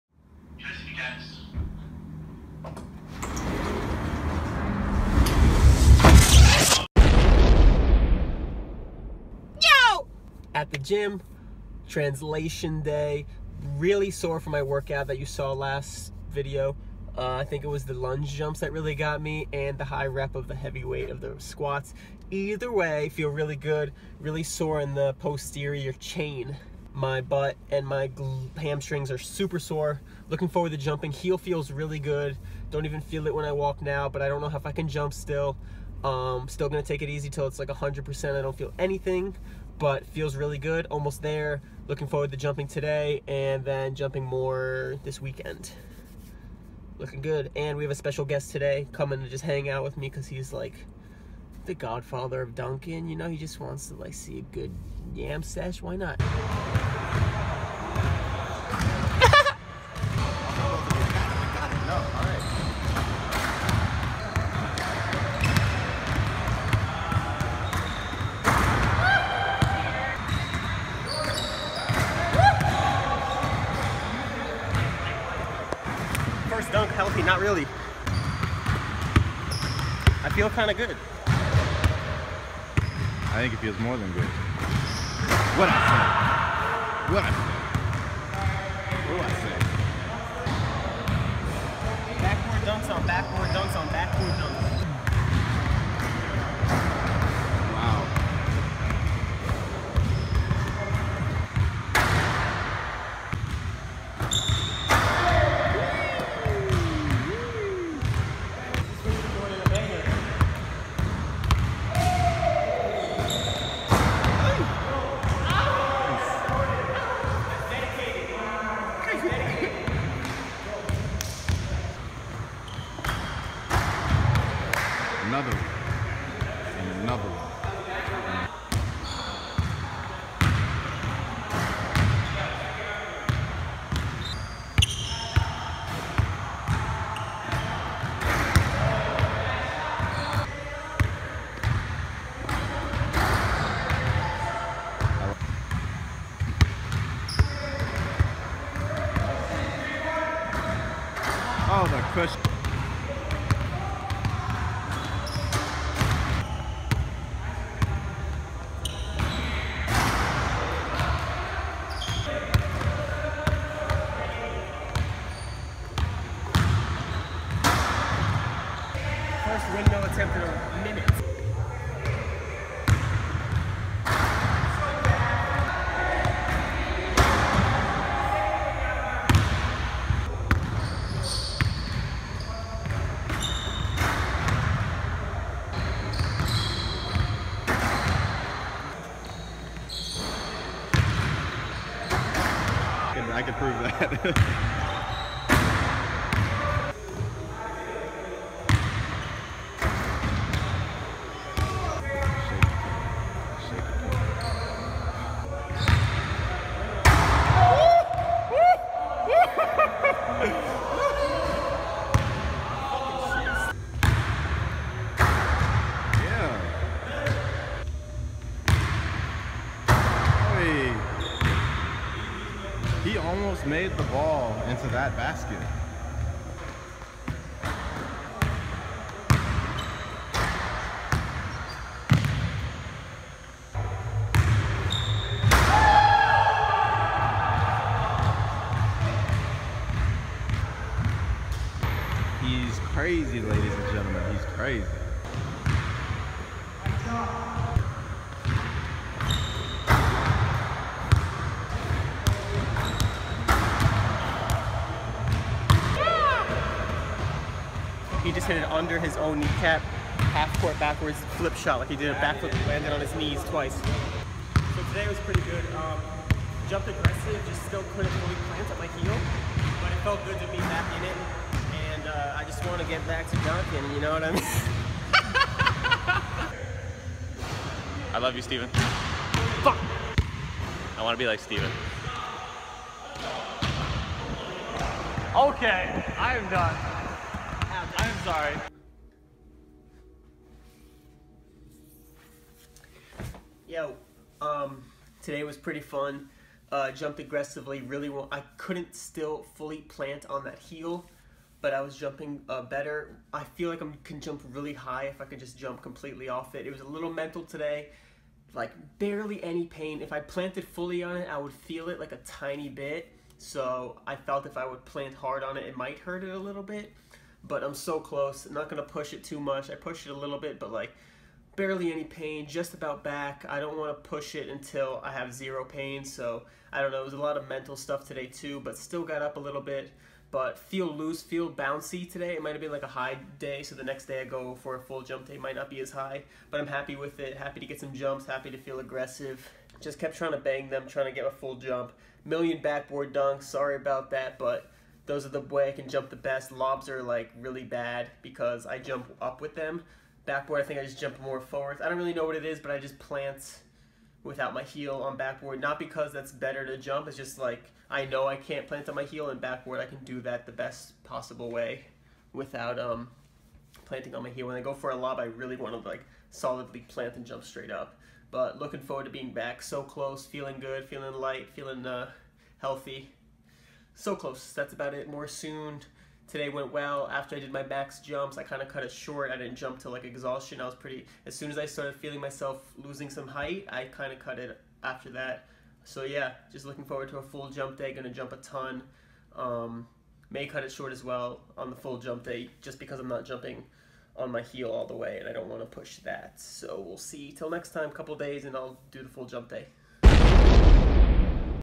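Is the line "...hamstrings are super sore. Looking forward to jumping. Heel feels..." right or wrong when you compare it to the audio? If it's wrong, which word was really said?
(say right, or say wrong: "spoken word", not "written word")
right.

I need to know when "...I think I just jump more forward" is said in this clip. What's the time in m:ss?
5:50.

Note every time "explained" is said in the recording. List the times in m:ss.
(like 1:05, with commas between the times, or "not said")
not said.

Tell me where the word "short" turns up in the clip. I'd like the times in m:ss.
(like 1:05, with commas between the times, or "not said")
6:18, 6:30.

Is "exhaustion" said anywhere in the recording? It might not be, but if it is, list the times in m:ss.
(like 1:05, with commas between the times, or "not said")
6:20.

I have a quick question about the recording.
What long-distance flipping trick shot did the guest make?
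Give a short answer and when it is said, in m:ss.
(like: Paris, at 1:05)
Half court backwards flip shot, at 4:20.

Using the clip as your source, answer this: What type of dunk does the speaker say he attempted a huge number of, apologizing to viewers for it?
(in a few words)
Backboard dunks.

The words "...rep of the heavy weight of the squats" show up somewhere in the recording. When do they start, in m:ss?
0:20.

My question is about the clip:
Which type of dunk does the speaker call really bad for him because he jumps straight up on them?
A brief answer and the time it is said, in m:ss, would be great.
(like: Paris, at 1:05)
Lobs, at 5:46.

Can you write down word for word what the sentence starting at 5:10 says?
If I planted fully on it, I would feel it like a tiny bit.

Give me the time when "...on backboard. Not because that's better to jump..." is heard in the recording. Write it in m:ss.
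5:55.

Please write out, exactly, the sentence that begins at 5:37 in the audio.
Happy to get some jumps, happy to feel aggressive.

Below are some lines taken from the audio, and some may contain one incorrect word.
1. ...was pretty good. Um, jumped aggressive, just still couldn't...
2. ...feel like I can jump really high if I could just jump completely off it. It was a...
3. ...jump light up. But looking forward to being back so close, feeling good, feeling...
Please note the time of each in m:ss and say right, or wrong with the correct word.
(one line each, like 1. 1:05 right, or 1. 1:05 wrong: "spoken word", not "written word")
1. 4:25 right
2. 5:03 right
3. 6:07 wrong: "straight", not "light".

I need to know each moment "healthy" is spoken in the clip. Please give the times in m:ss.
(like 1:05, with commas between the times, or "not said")
1:16, 6:12.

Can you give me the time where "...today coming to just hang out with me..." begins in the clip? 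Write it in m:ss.
0:48.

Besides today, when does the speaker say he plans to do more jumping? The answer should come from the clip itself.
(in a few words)
This weekend.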